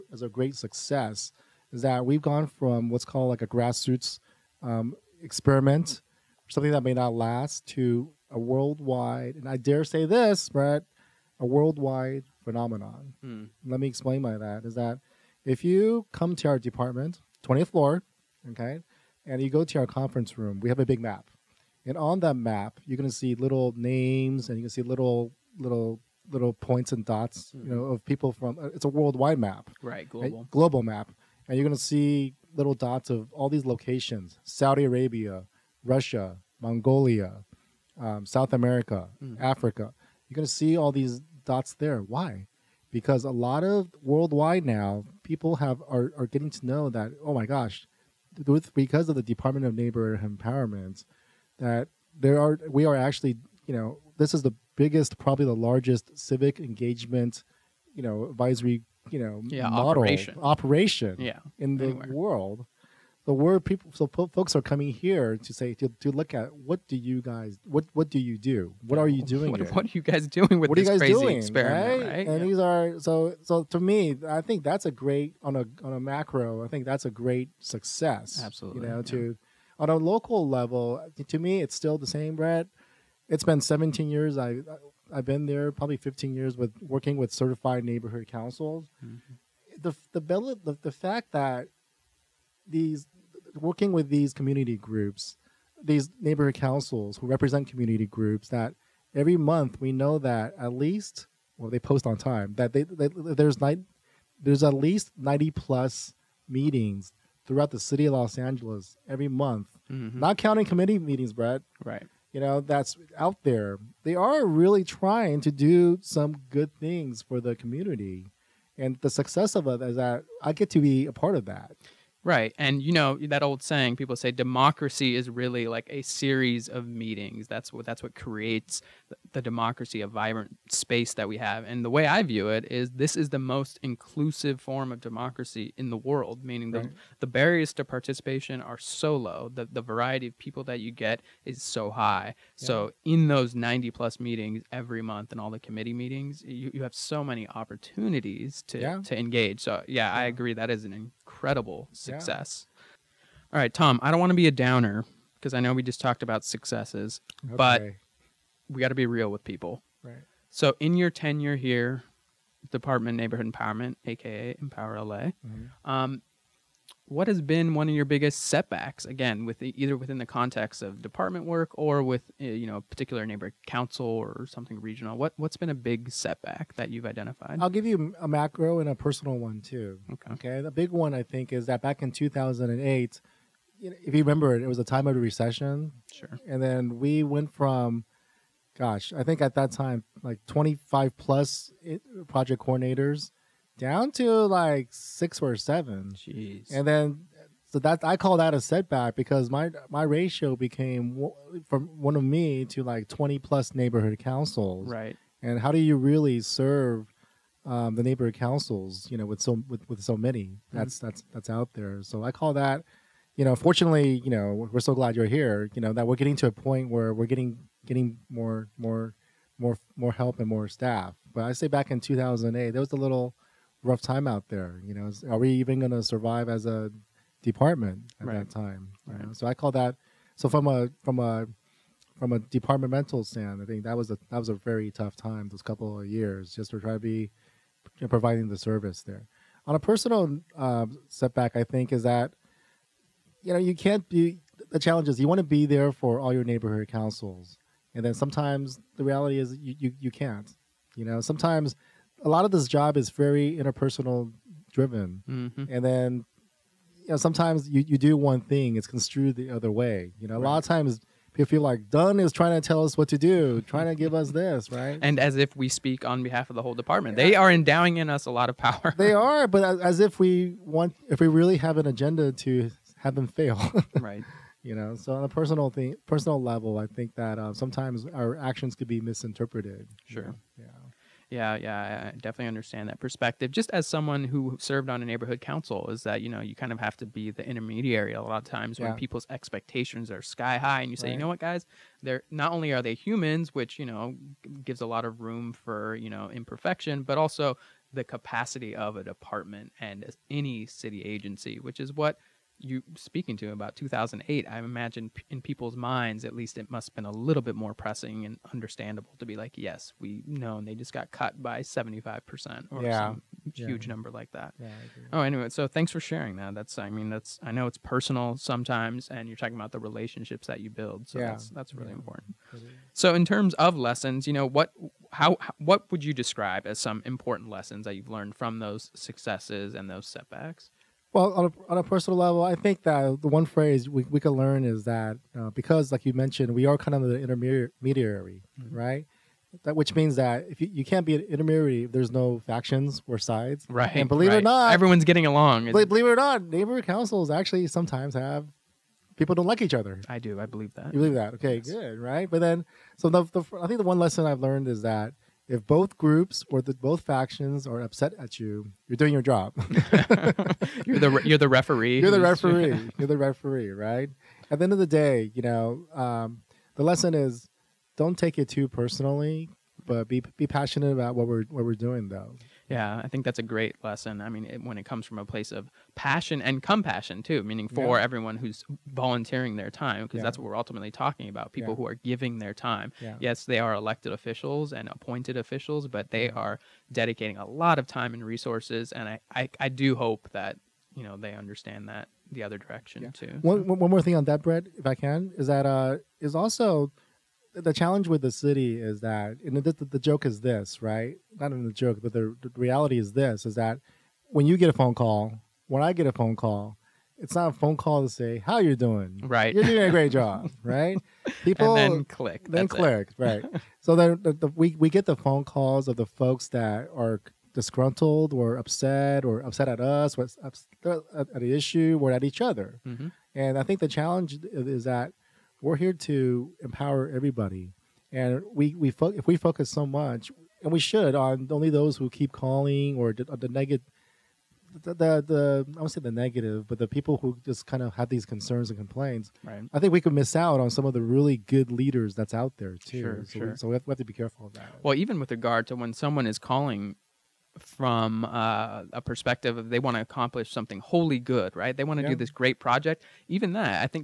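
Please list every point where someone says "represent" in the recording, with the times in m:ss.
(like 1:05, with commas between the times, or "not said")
1:37.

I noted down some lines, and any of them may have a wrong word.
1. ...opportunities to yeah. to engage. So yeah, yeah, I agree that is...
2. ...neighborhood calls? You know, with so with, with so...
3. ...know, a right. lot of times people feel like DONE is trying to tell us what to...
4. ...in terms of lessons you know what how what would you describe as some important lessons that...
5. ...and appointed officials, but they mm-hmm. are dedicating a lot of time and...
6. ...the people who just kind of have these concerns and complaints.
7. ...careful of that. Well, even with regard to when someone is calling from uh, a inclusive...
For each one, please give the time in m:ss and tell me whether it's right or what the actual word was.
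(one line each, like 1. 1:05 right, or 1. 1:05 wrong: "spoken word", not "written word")
1. 2:27 right
2. 3:28 wrong: "councils", not "calls"
3. 4:20 right
4. 5:23 right
5. 6:24 right
6. 7:16 right
7. 7:24 wrong: "perspective", not "inclusive".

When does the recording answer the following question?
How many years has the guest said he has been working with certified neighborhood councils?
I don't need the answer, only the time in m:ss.
1:25.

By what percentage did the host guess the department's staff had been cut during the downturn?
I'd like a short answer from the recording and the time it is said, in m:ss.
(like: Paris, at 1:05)
75%, at 5:11.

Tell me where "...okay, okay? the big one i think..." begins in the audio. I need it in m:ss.
3:00.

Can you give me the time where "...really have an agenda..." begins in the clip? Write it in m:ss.
4:31.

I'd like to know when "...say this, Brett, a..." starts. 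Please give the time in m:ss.
0:09.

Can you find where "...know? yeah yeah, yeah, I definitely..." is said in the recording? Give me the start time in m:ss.
4:40.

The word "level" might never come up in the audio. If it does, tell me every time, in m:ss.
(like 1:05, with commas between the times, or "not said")
1:20, 4:36, 5:32.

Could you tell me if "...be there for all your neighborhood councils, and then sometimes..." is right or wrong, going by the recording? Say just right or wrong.
right.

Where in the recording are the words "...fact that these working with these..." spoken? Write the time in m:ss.
1:30.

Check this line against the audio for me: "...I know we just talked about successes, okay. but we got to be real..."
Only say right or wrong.
right.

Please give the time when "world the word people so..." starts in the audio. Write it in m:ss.
1:02.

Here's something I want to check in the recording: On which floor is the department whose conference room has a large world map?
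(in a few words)
20th floor.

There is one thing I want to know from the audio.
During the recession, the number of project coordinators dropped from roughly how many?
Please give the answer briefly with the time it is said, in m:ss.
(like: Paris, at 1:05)
25 plus, at 3:10.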